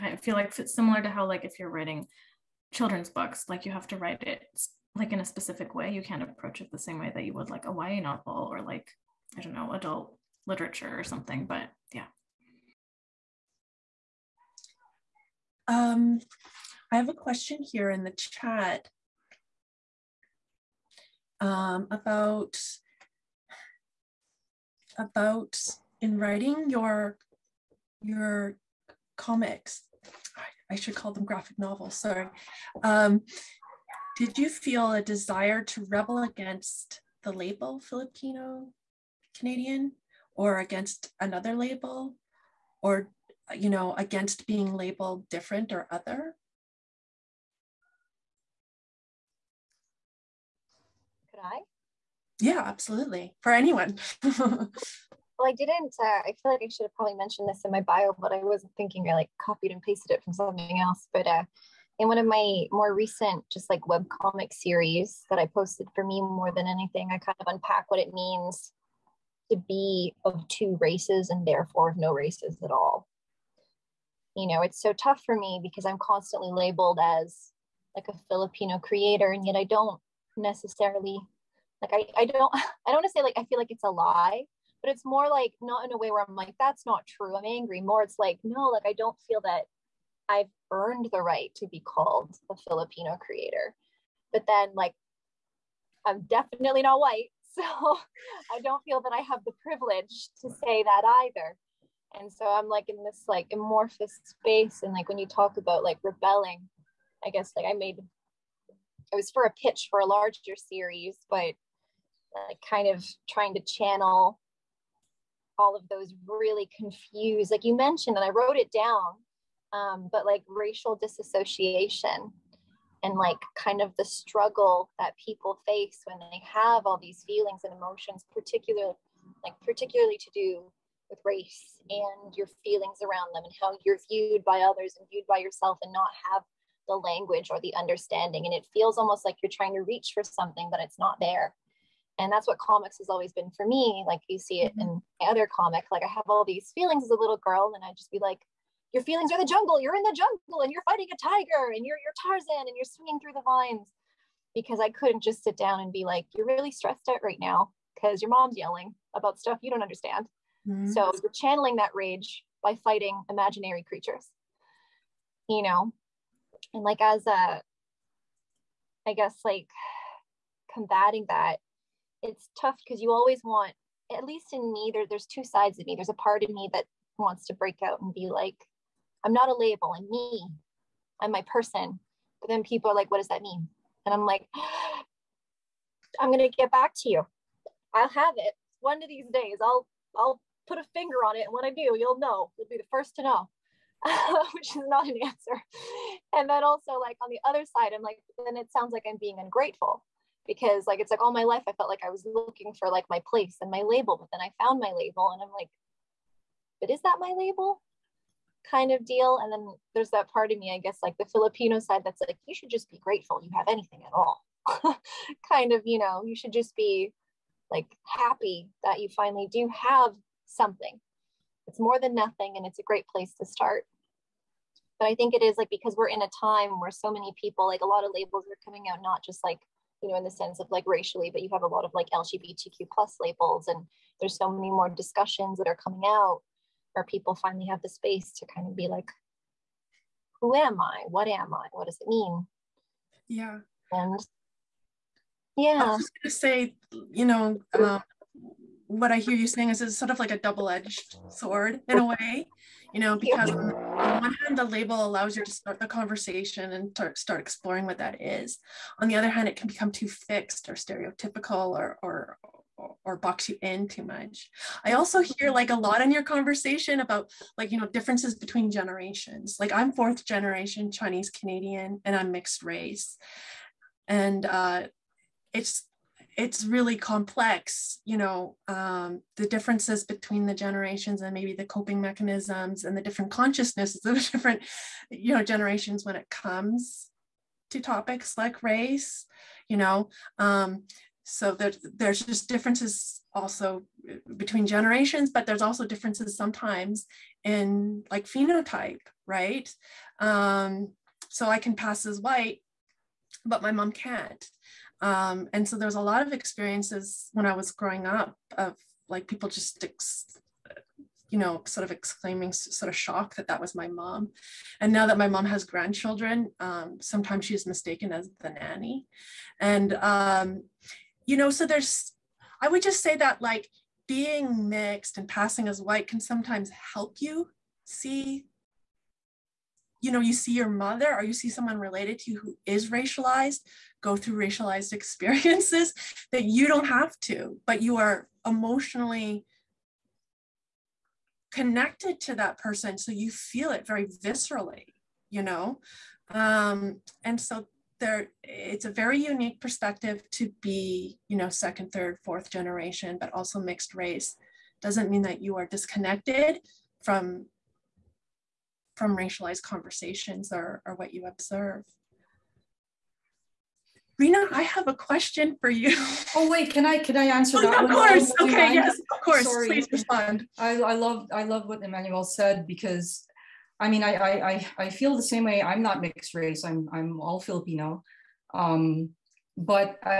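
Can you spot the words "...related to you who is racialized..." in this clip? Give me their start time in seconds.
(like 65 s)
331 s.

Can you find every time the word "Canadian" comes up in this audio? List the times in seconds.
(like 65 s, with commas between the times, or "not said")
39 s, 271 s.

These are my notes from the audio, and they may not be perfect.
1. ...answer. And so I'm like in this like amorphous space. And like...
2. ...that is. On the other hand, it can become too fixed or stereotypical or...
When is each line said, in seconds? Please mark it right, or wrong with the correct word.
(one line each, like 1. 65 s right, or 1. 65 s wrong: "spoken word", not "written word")
1. 101 s wrong: "either", not "answer"
2. 257 s right.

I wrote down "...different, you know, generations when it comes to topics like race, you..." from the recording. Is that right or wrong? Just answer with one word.
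right.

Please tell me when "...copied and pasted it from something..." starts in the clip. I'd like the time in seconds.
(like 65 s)
59 s.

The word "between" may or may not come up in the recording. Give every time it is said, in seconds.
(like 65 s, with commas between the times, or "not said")
268 s, 280 s, 294 s.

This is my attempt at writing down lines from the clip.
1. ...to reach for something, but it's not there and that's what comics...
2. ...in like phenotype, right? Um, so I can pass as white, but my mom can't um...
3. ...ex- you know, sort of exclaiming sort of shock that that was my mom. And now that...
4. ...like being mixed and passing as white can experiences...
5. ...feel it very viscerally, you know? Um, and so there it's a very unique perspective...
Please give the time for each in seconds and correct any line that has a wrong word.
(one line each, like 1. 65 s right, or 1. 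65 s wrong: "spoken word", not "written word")
1. 139 s right
2. 297 s right
3. 309 s right
4. 323 s wrong: "sometimes", not "experiences"
5. 343 s right.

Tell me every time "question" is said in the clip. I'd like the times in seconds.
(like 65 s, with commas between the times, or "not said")
17 s, 364 s.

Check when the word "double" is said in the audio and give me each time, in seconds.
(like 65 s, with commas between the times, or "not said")
250 s.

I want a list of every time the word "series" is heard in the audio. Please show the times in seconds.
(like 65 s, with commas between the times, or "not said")
64 s, 110 s.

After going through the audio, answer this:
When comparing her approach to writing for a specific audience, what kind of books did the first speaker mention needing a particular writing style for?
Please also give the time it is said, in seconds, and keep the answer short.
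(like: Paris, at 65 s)
children's books, at 2 s.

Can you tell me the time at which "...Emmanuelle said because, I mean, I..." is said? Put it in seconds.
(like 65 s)
371 s.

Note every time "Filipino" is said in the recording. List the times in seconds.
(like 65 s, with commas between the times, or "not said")
37 s, 78 s, 92 s, 211 s, 377 s.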